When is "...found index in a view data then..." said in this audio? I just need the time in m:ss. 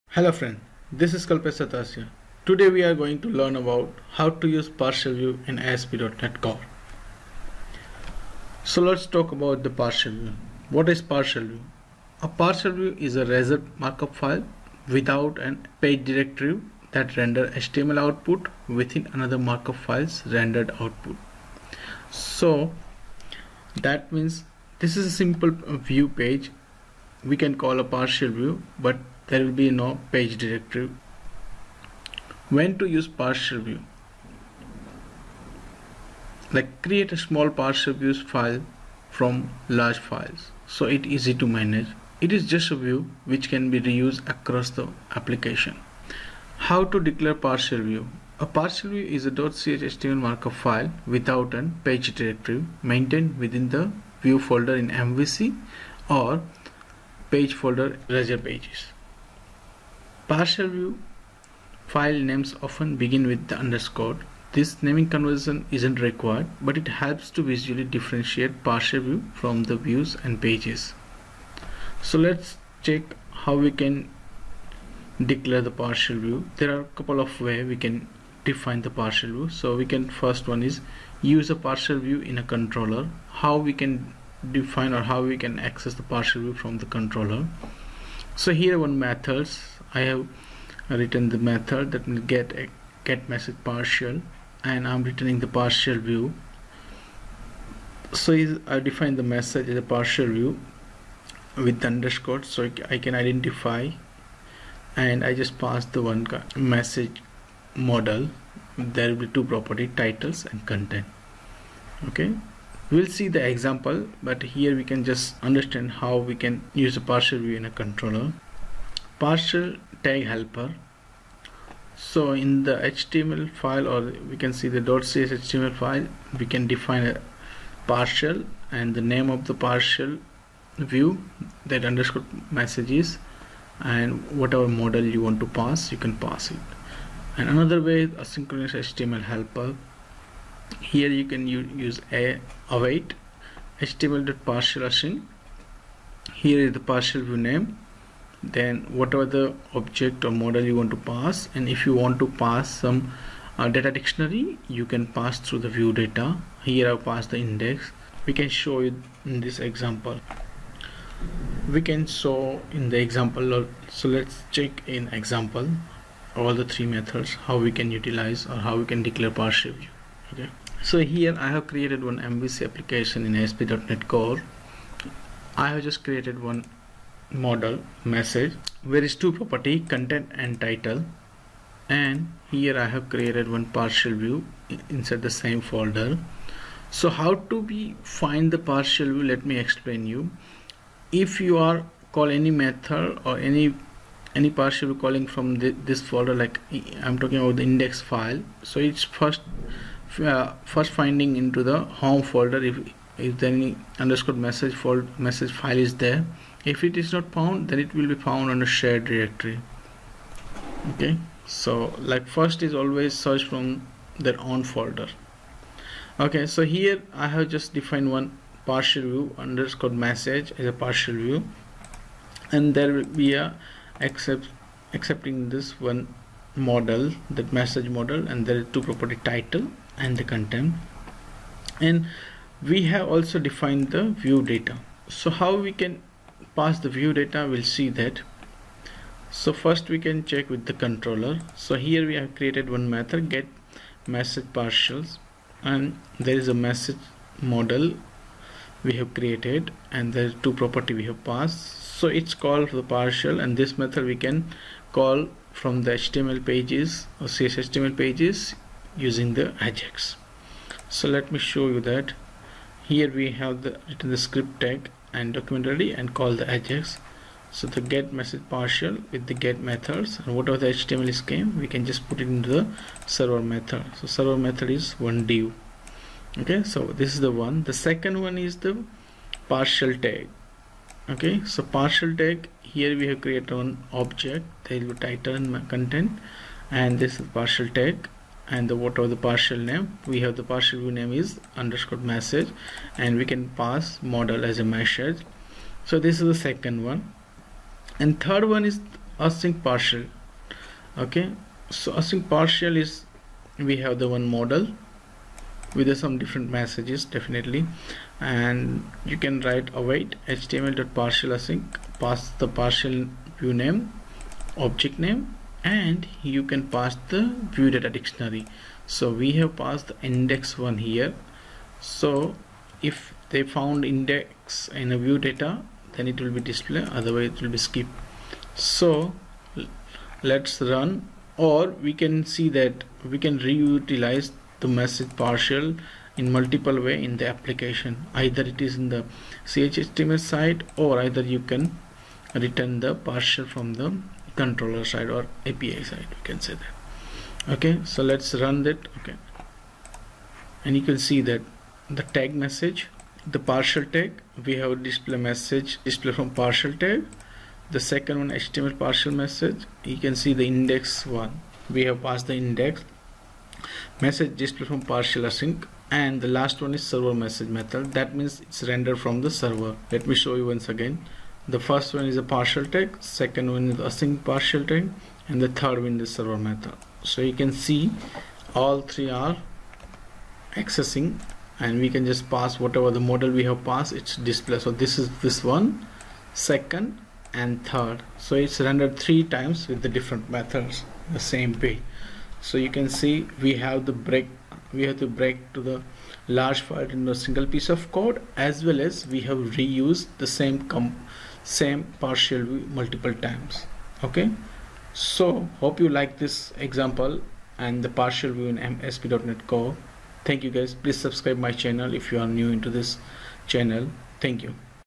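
5:23.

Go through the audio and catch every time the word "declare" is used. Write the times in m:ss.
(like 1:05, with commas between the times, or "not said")
0:46, 1:15, 2:49.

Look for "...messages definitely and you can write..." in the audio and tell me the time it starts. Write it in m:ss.
5:06.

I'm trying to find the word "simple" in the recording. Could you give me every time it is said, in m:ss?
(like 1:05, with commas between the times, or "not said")
0:25.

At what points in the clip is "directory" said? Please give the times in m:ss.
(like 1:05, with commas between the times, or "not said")
0:16, 0:30, 0:52, 3:29.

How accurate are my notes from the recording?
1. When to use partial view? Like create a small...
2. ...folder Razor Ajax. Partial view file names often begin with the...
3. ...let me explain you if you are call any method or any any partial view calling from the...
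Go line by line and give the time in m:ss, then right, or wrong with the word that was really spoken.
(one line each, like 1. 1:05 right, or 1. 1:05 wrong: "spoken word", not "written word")
1. 0:32 right
2. 0:57 wrong: "Pages", not "Ajax"
3. 3:09 right.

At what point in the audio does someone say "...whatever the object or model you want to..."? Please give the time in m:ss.
2:28.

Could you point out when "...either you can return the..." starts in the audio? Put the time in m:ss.
5:41.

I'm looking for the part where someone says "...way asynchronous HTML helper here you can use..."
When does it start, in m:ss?
2:17.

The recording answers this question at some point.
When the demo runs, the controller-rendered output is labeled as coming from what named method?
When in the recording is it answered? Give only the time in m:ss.
6:06.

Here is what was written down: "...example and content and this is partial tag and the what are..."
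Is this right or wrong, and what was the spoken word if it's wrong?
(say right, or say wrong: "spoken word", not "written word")
wrong: "title", not "example".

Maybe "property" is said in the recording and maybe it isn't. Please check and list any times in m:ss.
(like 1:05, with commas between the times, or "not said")
1:49, 2:59, 3:48, 4:10.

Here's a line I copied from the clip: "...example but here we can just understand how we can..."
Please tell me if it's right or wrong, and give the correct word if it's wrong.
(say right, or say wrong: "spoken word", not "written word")
right.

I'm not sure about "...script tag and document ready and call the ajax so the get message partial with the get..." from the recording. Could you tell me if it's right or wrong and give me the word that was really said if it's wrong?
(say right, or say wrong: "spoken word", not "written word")
right.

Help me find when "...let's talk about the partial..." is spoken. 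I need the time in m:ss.
0:08.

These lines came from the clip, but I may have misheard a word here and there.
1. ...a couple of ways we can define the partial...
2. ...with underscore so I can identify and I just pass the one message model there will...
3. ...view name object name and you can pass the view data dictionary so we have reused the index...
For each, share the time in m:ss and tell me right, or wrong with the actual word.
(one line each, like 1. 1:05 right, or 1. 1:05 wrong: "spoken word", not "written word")
1. 1:16 right
2. 1:41 right
3. 5:13 wrong: "passed", not "reused".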